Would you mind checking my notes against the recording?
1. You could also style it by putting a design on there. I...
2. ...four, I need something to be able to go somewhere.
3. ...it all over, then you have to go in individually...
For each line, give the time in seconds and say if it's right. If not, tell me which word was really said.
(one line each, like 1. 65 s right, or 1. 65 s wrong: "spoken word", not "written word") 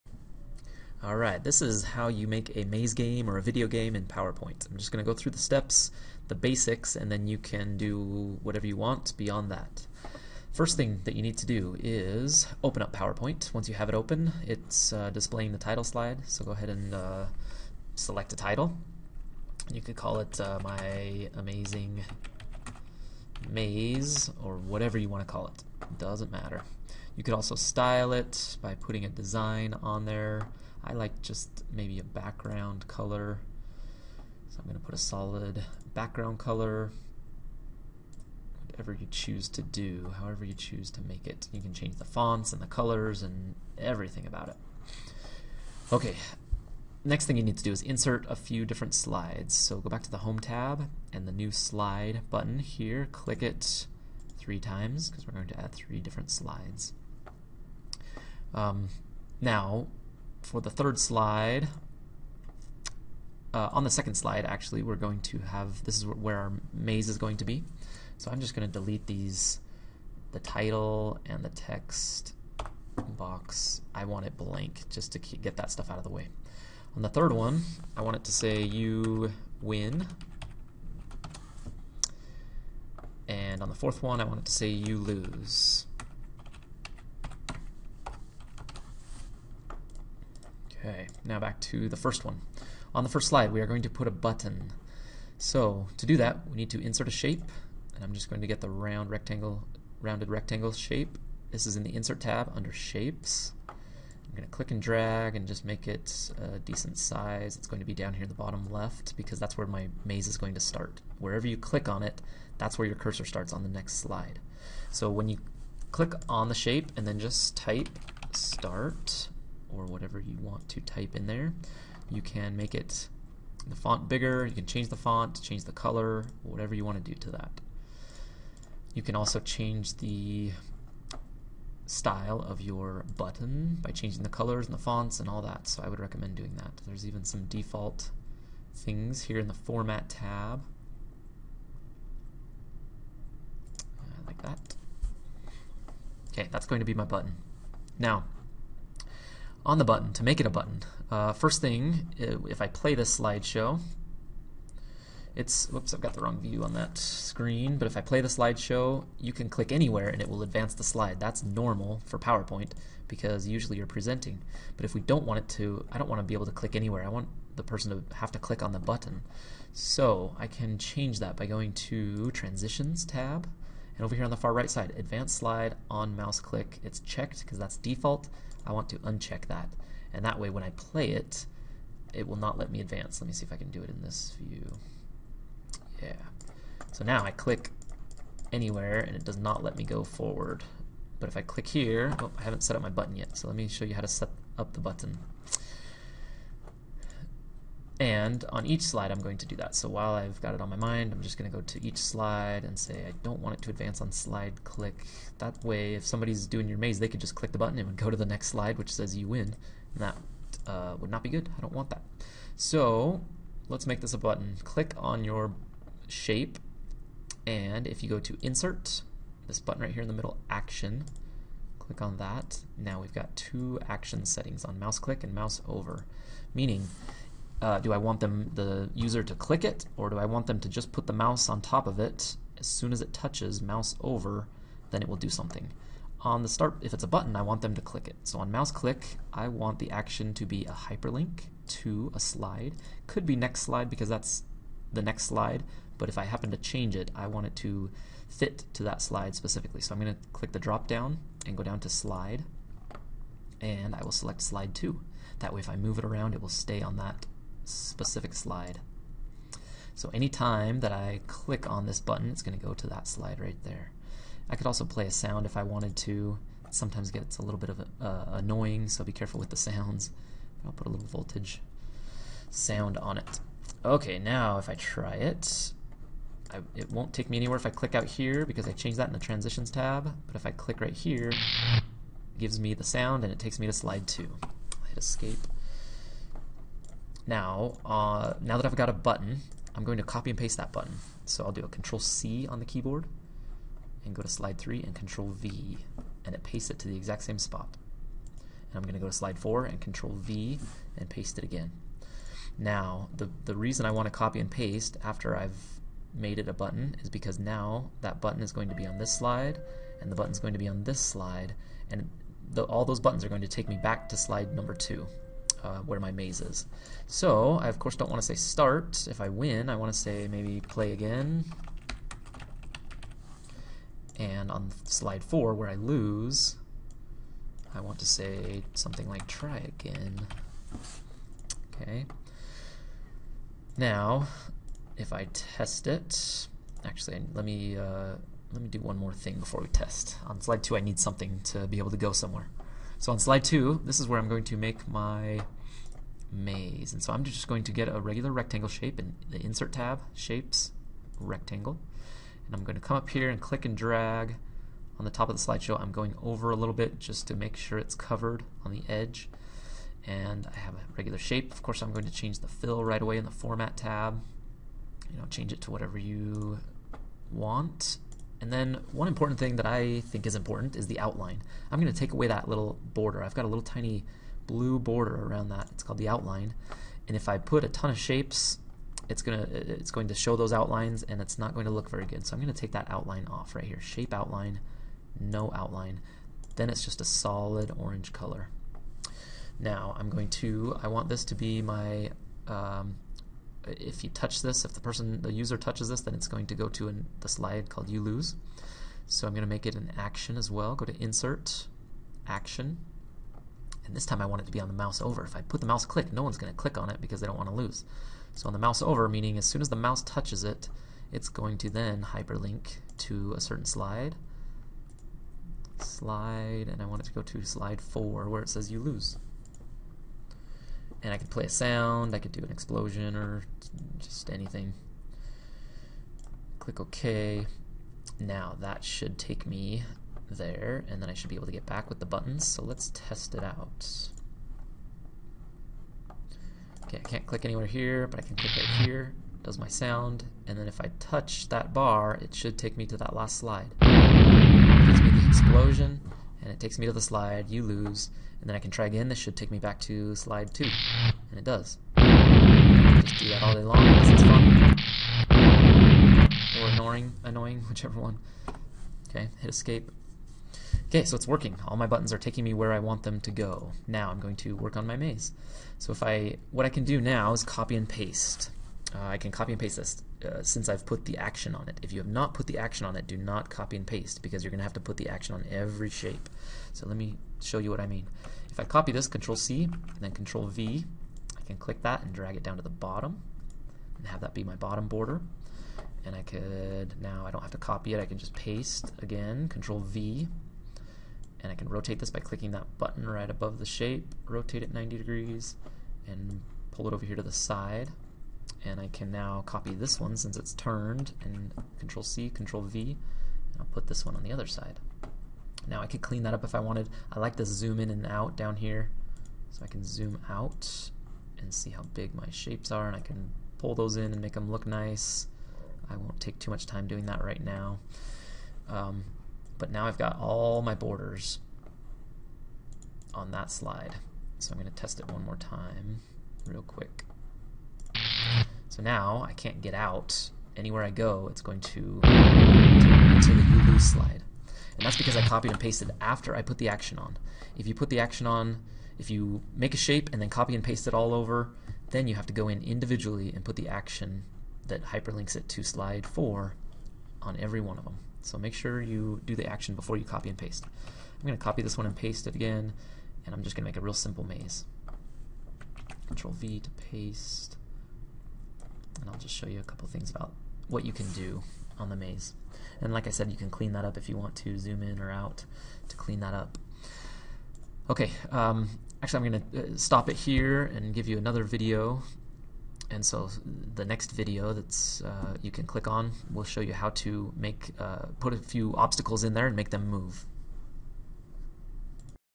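1. 27 s right
2. 340 s wrong: "two", not "four"
3. 540 s right.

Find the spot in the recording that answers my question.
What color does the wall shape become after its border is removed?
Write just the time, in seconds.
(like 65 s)
387 s.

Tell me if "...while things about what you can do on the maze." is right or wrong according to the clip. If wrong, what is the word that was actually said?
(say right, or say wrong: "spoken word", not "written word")
wrong: "couple", not "while".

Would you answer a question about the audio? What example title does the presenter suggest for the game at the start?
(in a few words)
My Amazing Maze.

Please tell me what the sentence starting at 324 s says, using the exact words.
And on slide four, where I lose, I want to say something like try again.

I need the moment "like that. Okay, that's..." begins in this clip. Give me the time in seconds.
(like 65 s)
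144 s.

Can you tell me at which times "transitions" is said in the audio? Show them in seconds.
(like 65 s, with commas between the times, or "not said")
172 s, 279 s.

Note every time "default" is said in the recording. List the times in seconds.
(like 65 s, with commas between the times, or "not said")
137 s, 177 s.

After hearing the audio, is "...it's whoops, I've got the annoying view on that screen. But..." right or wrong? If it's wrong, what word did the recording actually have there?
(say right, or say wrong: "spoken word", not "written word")
wrong: "wrong", not "annoying".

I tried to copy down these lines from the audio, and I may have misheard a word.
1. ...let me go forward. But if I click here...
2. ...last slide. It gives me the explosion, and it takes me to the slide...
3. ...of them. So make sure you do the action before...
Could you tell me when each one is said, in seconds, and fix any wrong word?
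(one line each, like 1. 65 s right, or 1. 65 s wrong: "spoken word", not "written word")
1. 189 s right
2. 443 s right
3. 547 s right.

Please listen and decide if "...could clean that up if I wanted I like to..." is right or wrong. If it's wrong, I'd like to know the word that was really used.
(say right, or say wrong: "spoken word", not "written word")
right.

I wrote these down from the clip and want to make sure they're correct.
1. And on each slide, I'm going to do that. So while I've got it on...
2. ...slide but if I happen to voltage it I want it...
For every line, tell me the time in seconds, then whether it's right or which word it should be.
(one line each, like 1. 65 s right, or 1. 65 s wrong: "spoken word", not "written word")
1. 198 s right
2. 245 s wrong: "change", not "voltage".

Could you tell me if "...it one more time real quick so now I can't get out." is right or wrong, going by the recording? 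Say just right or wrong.
right.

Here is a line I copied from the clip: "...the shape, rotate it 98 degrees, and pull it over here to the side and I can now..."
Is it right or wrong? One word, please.
wrong.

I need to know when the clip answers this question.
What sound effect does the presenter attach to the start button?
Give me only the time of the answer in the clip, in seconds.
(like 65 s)
271 s.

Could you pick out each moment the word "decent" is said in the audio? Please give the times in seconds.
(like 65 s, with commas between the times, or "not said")
106 s.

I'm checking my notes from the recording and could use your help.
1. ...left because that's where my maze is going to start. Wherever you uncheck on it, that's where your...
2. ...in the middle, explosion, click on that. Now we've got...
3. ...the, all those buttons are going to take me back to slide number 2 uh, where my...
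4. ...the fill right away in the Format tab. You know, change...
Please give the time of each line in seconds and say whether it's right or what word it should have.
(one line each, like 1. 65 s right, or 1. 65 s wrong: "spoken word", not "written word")
1. 108 s wrong: "click", not "uncheck"
2. 220 s wrong: "action", not "explosion"
3. 312 s right
4. 362 s right.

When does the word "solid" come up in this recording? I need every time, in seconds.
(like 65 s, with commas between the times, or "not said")
34 s, 387 s.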